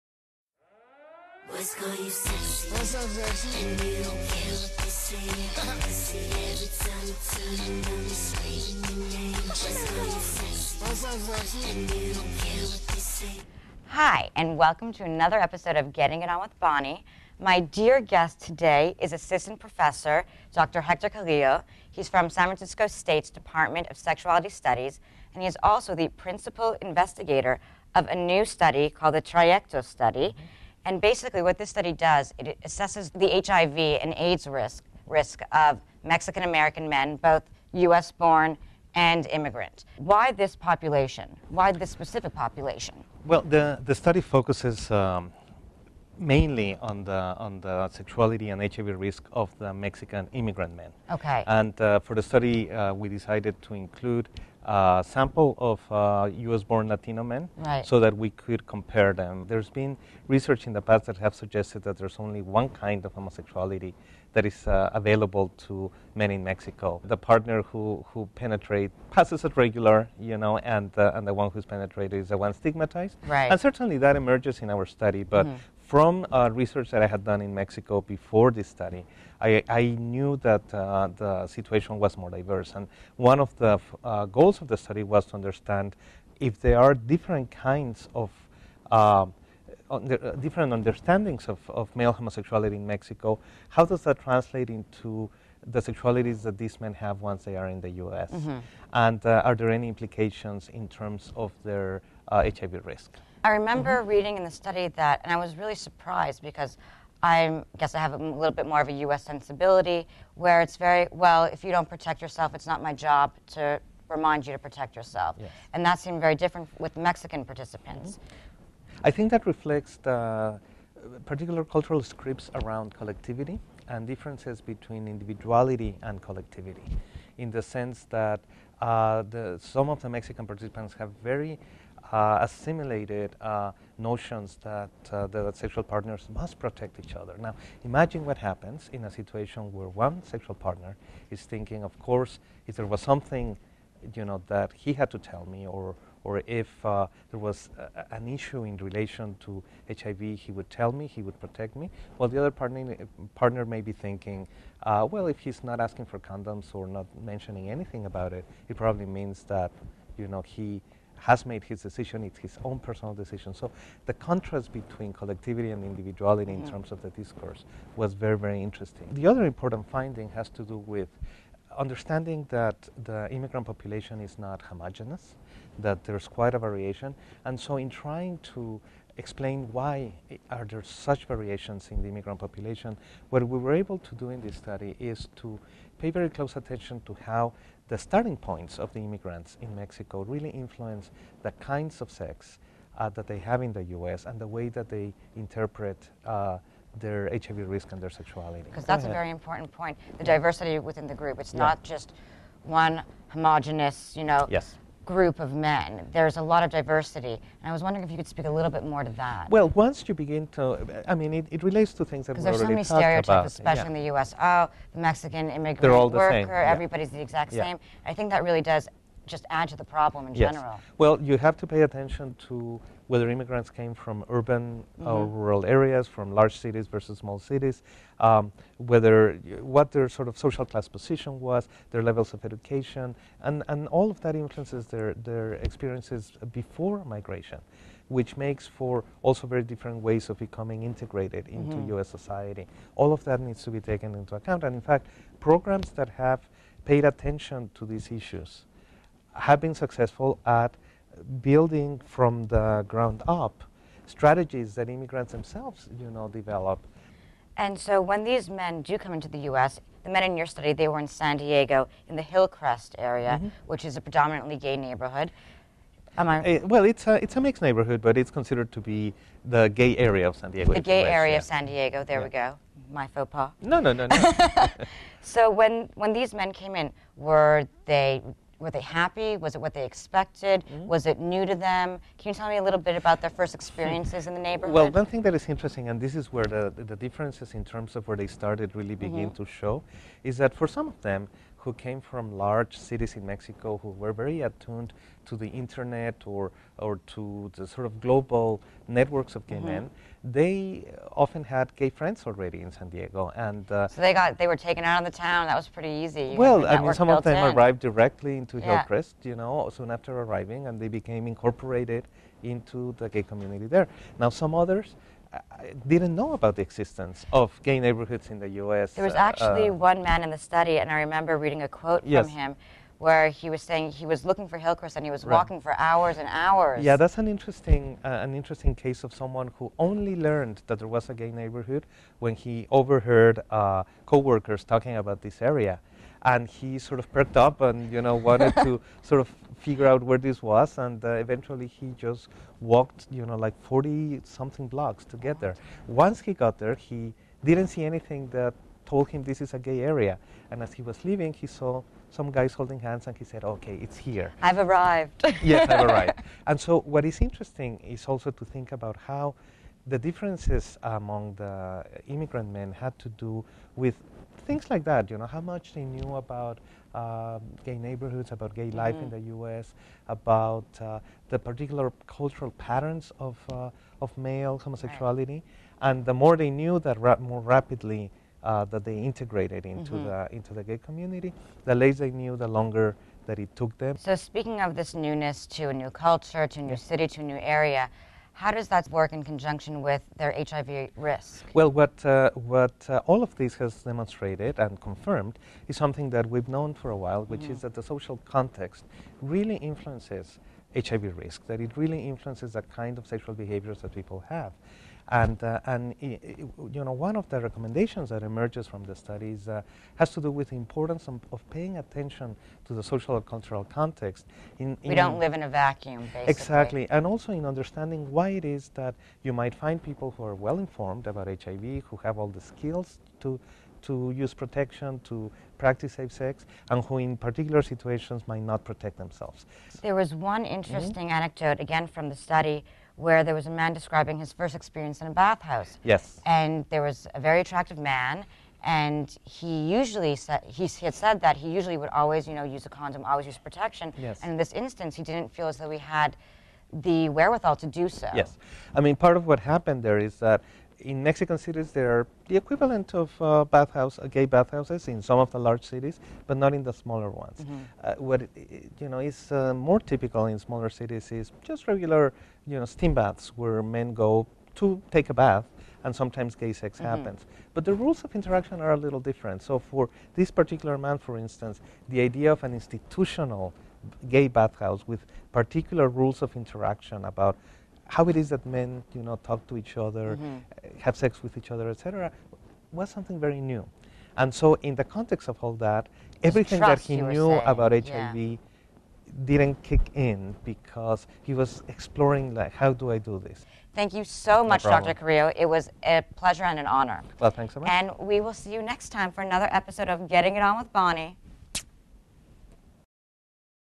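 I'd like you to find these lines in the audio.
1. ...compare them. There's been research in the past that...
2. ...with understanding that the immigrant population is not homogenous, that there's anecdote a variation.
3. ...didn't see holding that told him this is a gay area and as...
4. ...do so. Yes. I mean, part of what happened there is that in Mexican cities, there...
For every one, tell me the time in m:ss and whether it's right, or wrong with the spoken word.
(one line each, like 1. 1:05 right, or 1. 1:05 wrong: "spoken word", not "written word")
1. 0:58 right
2. 2:50 wrong: "quite", not "anecdote"
3. 5:47 wrong: "anything", not "holding"
4. 7:27 right.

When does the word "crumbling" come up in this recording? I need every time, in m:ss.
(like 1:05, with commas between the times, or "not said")
not said.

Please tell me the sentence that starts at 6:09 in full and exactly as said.
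the U.S., about uh, the particular cultural patterns of, uh, of male homosexuality.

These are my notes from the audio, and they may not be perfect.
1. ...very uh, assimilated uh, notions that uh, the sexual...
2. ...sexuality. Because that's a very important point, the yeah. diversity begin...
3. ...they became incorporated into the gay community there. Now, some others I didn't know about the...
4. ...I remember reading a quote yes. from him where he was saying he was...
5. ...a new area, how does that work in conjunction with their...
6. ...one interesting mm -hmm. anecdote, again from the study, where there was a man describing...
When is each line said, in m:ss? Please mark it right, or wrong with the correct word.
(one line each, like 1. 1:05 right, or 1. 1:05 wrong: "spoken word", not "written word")
1. 2:11 right
2. 3:18 wrong: "within", not "begin"
3. 5:10 right
4. 5:20 right
5. 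6:27 right
6. 7:10 right.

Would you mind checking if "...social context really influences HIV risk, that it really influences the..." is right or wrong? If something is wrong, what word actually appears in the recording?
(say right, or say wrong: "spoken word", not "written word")
right.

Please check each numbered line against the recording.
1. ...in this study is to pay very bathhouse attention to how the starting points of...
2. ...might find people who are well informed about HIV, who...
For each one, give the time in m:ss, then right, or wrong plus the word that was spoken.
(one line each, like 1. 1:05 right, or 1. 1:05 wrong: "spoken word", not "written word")
1. 3:04 wrong: "close", not "bathhouse"
2. 6:59 right.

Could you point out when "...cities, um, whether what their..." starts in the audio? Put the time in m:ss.
3:47.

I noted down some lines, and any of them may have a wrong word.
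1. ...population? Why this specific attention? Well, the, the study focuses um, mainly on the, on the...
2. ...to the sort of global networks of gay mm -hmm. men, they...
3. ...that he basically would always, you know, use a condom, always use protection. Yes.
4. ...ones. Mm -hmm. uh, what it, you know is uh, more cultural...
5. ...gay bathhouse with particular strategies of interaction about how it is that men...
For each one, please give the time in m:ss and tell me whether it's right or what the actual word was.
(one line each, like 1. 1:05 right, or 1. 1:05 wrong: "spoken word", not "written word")
1. 0:40 wrong: "population", not "attention"
2. 4:57 right
3. 7:21 wrong: "usually", not "basically"
4. 7:37 wrong: "typical", not "cultural"
5. 7:54 wrong: "rules", not "strategies".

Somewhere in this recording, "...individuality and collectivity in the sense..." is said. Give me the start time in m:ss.
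2:05.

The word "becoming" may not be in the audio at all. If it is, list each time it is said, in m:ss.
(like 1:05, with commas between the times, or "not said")
4:00.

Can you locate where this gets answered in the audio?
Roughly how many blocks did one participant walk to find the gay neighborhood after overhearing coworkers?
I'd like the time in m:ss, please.
5:43.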